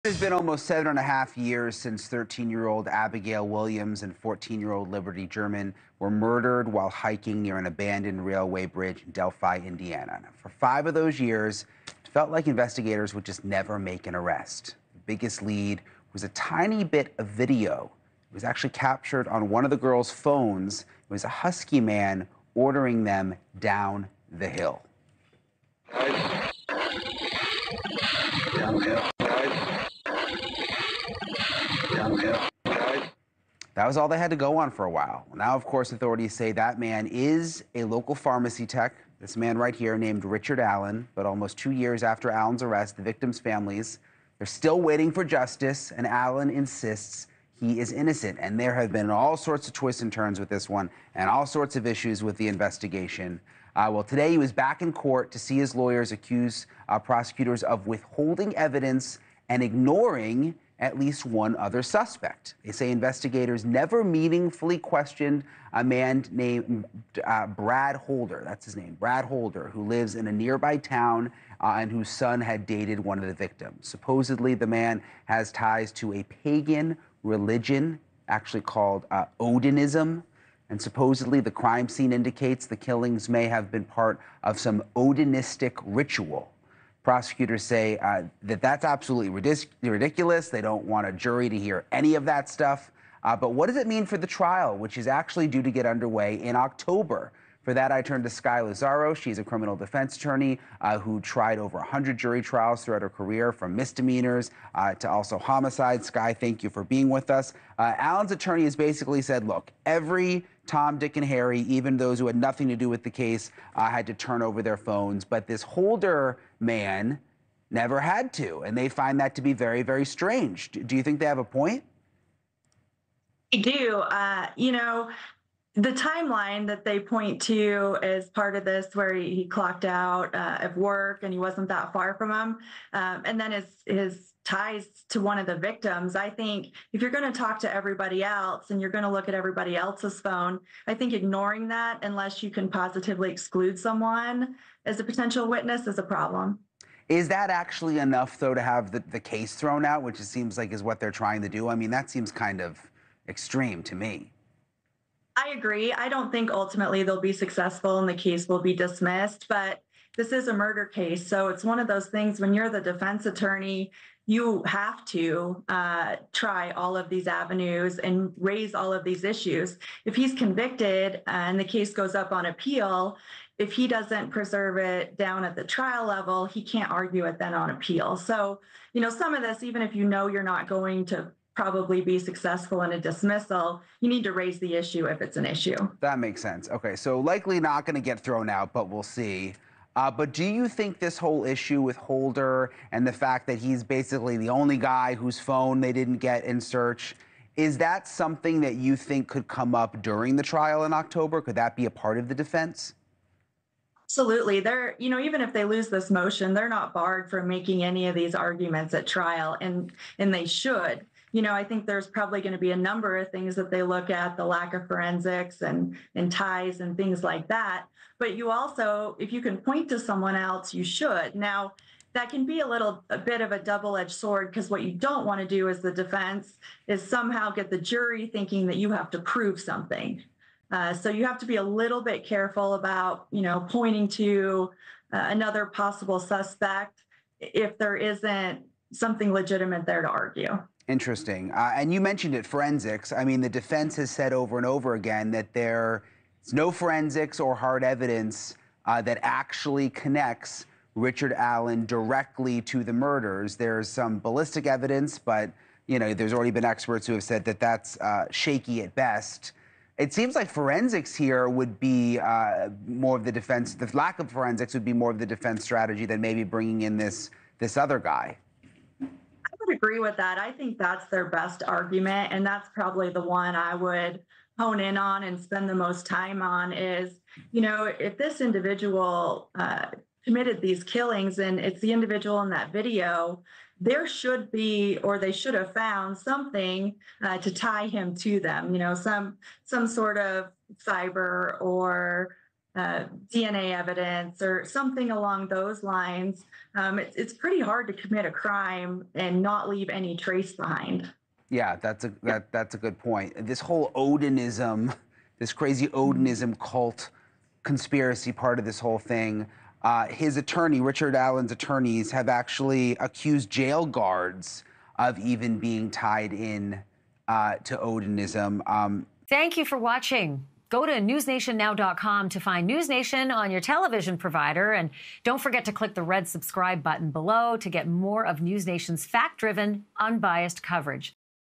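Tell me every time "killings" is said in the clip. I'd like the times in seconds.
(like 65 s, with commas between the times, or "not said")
82 s, 280 s.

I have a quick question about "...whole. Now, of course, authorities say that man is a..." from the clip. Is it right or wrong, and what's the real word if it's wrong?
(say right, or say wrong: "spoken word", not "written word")
wrong: "while", not "whole".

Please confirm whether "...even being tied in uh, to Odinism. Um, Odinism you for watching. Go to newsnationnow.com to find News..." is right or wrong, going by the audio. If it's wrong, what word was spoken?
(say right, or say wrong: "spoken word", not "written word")
wrong: "Thank", not "Odinism".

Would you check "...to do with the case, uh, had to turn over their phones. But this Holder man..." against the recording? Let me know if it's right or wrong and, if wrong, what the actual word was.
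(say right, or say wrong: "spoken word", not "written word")
right.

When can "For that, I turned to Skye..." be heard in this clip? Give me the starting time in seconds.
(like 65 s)
97 s.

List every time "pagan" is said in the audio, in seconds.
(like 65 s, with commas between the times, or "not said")
76 s.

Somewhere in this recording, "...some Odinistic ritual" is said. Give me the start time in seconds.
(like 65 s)
84 s.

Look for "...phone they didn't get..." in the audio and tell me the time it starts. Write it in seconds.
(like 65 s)
195 s.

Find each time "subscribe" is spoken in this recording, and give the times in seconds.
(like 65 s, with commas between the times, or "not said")
326 s.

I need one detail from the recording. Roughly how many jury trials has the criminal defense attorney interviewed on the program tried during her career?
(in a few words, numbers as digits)
over 100.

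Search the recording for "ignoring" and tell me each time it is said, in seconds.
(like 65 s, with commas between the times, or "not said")
59 s, 141 s.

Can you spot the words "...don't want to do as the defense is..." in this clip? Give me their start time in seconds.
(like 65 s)
224 s.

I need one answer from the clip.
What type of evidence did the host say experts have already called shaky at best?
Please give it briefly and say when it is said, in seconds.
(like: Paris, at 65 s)
ballistic evidence, at 254 s.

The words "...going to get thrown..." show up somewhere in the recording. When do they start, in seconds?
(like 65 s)
187 s.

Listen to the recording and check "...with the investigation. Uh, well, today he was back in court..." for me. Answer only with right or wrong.
right.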